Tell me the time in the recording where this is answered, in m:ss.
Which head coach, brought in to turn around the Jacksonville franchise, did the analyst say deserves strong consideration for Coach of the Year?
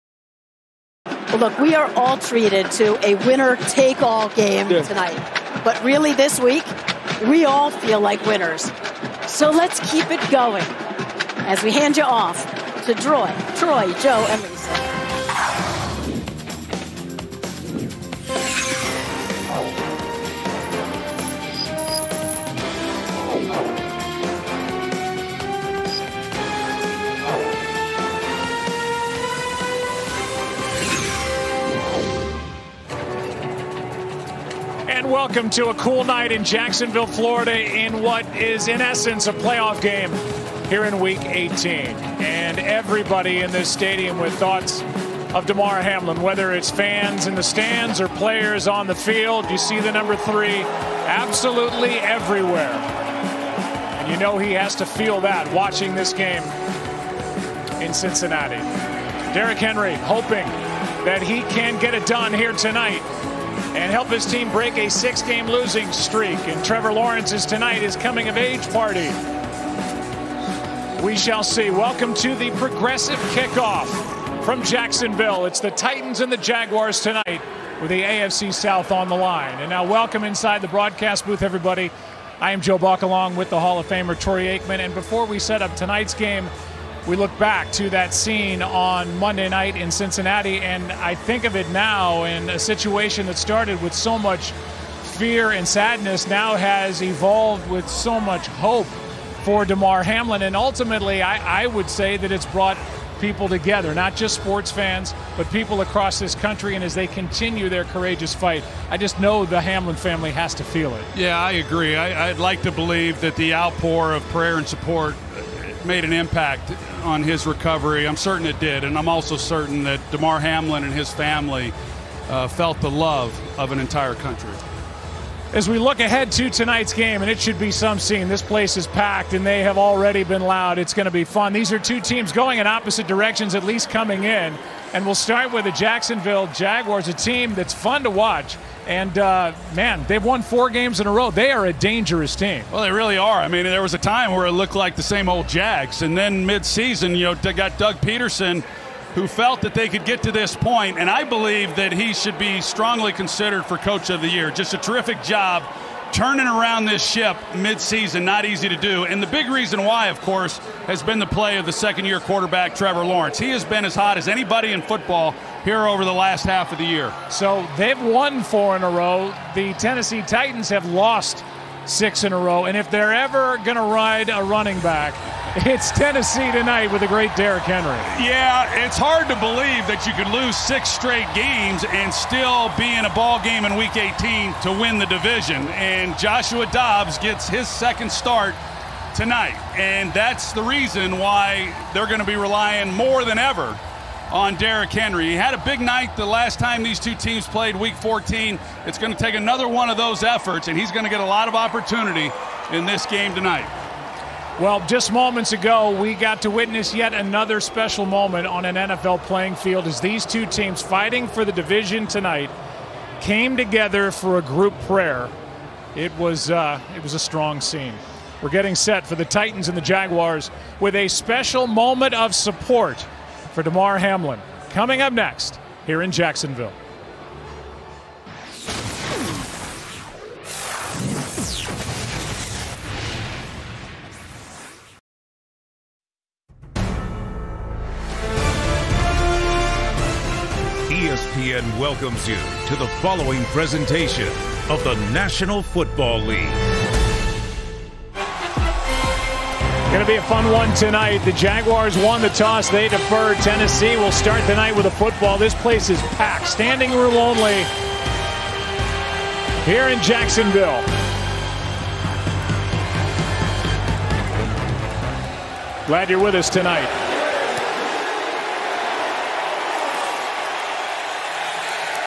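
2:27.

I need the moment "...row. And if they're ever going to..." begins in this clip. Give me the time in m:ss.
2:52.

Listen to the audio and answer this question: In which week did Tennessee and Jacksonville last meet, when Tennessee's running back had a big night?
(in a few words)
Week 14.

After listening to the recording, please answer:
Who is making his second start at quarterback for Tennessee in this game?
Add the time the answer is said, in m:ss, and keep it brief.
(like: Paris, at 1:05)
Joshua Dobbs, at 3:06.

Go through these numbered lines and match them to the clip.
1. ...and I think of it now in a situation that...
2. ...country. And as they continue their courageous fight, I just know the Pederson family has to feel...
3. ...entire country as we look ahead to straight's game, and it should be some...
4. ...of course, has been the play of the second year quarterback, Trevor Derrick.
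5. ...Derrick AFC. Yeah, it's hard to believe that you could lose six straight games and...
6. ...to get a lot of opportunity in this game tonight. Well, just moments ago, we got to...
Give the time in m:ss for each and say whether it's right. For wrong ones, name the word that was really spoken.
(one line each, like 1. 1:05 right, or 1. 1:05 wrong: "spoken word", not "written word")
1. 1:30 right
2. 1:46 wrong: "Hamlin", not "Pederson"
3. 2:03 wrong: "tonight", not "straight"
4. 2:40 wrong: "Lawrence", not "Derrick"
5. 2:57 wrong: "Henry", not "AFC"
6. 3:21 right.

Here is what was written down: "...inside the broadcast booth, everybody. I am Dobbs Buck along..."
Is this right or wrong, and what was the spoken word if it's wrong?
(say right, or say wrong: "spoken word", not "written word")
wrong: "Joe", not "Dobbs".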